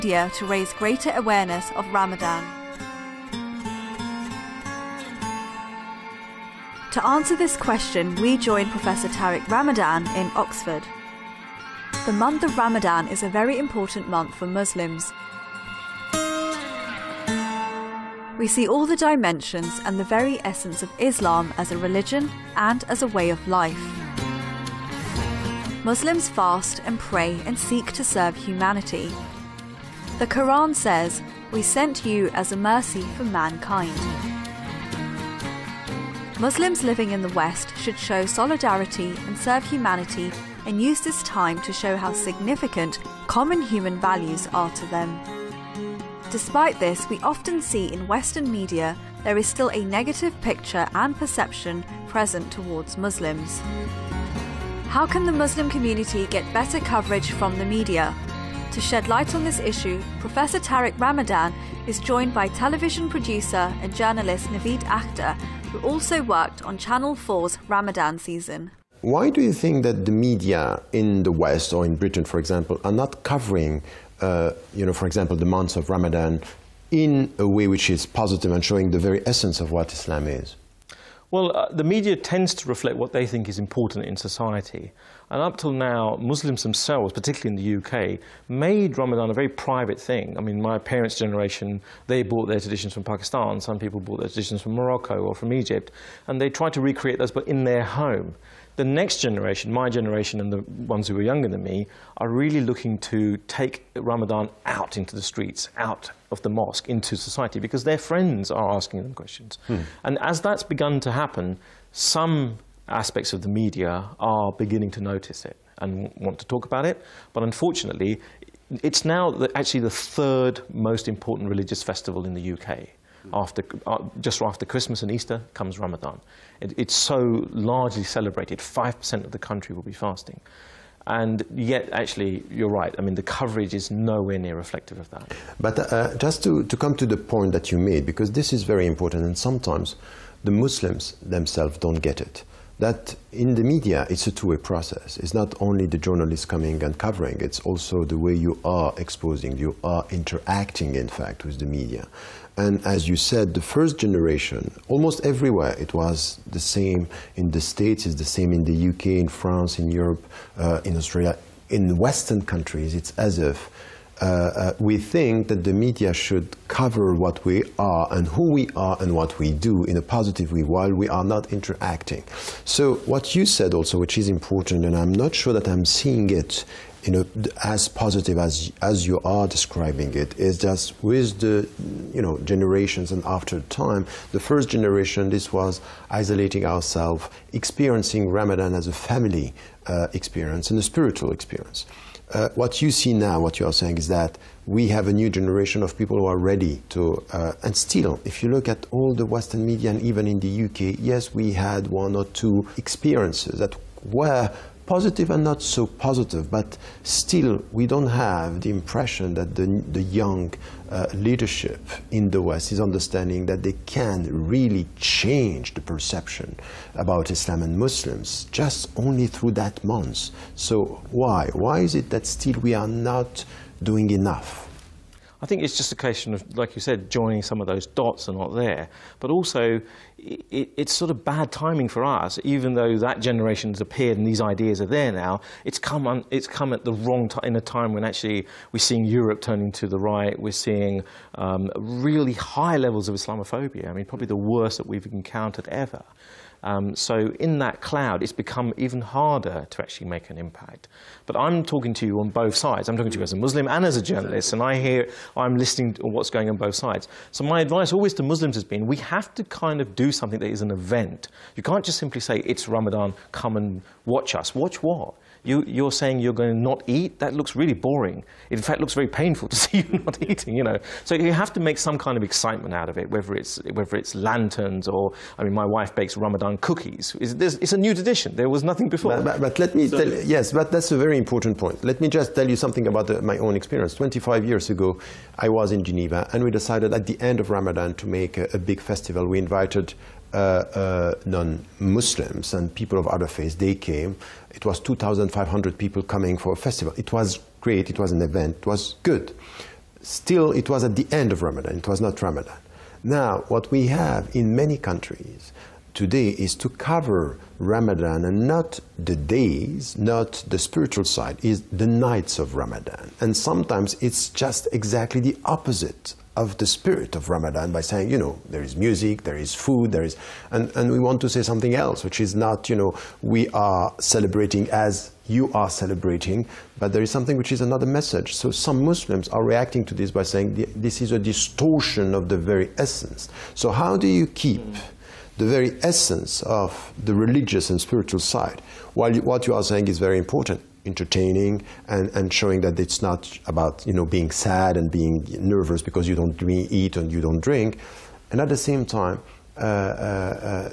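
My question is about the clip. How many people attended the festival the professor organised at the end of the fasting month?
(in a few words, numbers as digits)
2,500.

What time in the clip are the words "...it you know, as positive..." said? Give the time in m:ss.
2:56.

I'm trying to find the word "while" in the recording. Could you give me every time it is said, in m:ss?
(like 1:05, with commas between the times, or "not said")
2:50, 5:38.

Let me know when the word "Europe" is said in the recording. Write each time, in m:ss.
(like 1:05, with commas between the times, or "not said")
2:39, 3:59.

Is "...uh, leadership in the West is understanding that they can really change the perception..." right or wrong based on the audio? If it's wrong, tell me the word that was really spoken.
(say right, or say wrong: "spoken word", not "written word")
right.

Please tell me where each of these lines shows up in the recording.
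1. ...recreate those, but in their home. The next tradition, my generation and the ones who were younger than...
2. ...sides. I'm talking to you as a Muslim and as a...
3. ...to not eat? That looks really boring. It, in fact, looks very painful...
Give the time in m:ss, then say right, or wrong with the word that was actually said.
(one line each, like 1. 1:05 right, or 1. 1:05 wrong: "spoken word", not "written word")
1. 1:36 wrong: "generation", not "tradition"
2. 4:12 right
3. 4:26 right.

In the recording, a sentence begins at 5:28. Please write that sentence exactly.
So some Muslims are reacting to this by saying this is a distortion of the very essence.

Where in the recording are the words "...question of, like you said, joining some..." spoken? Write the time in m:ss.
3:45.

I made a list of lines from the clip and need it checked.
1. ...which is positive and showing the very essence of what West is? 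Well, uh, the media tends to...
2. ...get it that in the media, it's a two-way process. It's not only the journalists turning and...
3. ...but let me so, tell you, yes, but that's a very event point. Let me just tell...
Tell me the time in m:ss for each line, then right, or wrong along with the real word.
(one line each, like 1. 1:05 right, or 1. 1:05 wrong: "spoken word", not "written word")
1. 1:17 wrong: "Islam", not "West"
2. 2:22 wrong: "coming", not "turning"
3. 4:39 wrong: "important", not "event".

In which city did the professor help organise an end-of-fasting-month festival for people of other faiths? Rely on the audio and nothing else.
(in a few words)
Geneva.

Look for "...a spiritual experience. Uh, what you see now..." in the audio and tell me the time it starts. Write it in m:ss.
3:10.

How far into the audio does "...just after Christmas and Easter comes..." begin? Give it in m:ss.
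2:04.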